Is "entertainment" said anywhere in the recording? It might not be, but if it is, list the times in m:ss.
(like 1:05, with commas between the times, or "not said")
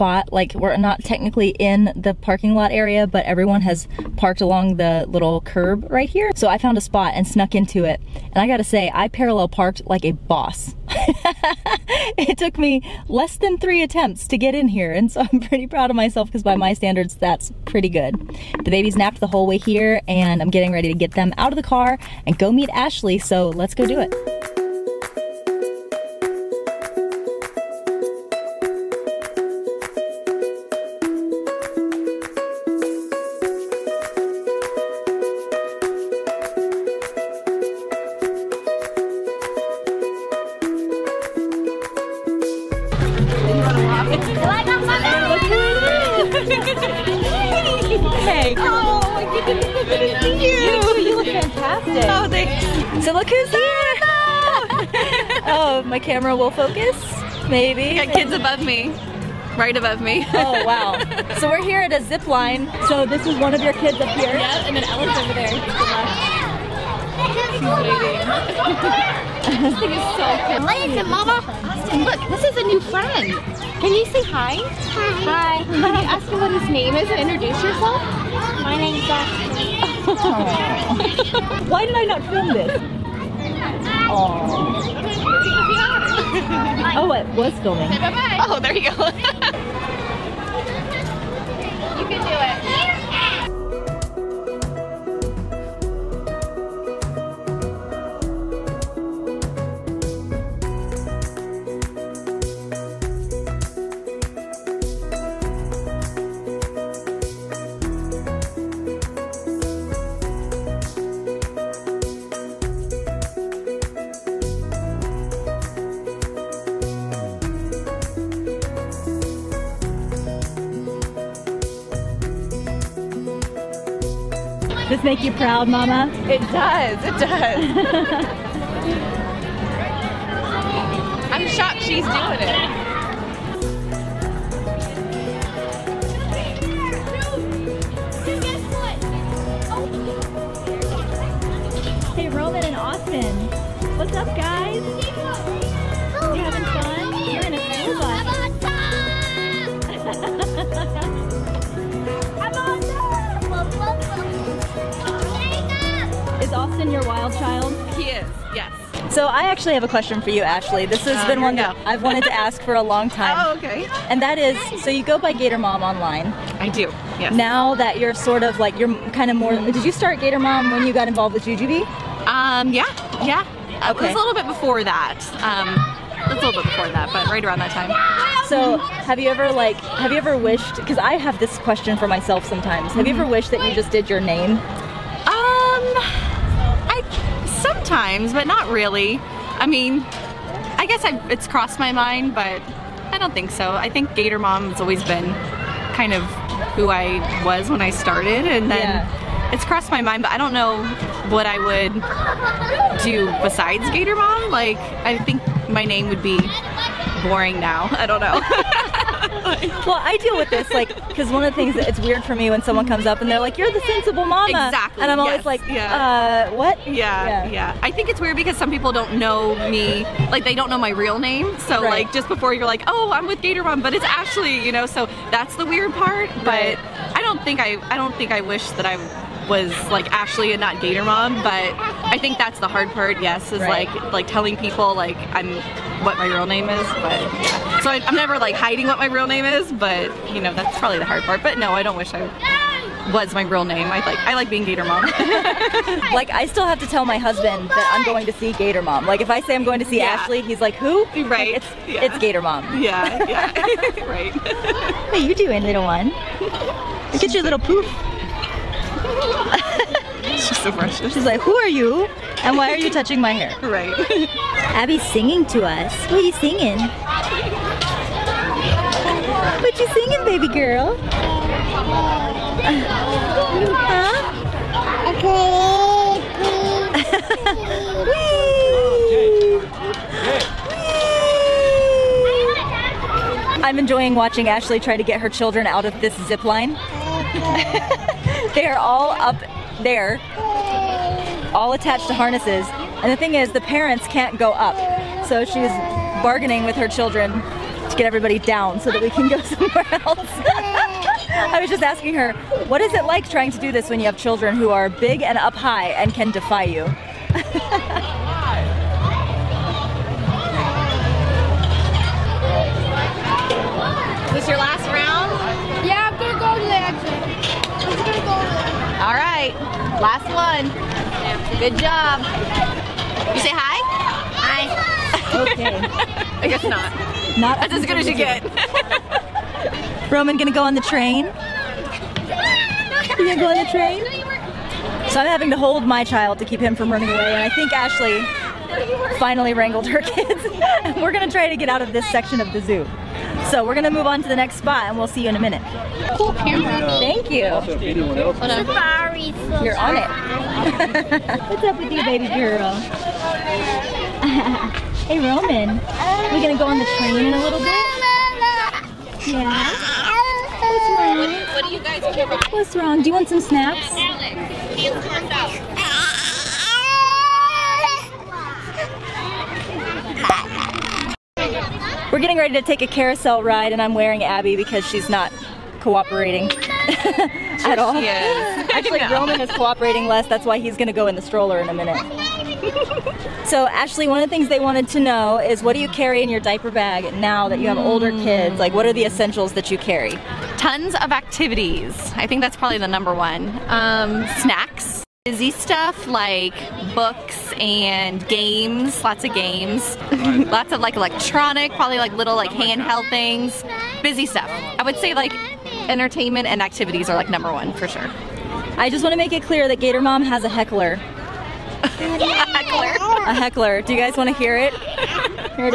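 6:45.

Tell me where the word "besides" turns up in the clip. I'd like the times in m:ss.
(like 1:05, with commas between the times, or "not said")
3:23.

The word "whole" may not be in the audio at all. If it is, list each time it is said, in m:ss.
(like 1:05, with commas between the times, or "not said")
0:19.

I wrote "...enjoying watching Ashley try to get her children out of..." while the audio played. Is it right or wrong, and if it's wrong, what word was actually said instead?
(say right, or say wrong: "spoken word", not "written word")
right.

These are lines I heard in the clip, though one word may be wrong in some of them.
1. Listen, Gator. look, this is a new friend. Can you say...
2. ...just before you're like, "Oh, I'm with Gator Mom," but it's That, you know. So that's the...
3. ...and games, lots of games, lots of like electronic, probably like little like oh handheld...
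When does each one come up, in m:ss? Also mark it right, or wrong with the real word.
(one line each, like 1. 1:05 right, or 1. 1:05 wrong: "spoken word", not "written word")
1. 1:10 wrong: "Mama", not "Gator"
2. 3:42 wrong: "Ashley", not "That"
3. 6:37 right.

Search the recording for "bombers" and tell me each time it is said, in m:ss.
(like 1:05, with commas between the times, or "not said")
not said.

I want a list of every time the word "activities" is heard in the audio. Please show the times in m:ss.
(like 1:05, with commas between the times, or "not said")
6:31, 6:46.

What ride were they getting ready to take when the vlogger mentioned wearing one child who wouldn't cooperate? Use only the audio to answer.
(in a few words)
Carousel.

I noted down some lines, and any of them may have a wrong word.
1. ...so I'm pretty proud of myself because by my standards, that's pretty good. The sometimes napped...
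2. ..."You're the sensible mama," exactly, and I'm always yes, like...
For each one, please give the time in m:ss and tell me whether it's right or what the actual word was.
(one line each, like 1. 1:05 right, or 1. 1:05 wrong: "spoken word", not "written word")
1. 0:15 wrong: "babies", not "sometimes"
2. 3:33 right.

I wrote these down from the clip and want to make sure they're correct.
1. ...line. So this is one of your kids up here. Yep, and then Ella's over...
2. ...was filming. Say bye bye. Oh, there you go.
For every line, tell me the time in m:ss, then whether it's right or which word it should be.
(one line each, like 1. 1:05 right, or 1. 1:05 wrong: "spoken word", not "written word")
1. 1:02 right
2. 1:27 right.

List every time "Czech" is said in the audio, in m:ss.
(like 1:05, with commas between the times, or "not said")
not said.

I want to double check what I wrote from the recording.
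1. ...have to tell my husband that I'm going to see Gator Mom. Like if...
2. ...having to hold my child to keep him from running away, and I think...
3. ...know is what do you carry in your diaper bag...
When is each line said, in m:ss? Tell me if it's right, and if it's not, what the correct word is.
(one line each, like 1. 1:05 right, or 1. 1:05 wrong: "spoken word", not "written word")
1. 4:06 right
2. 5:35 right
3. 6:24 right.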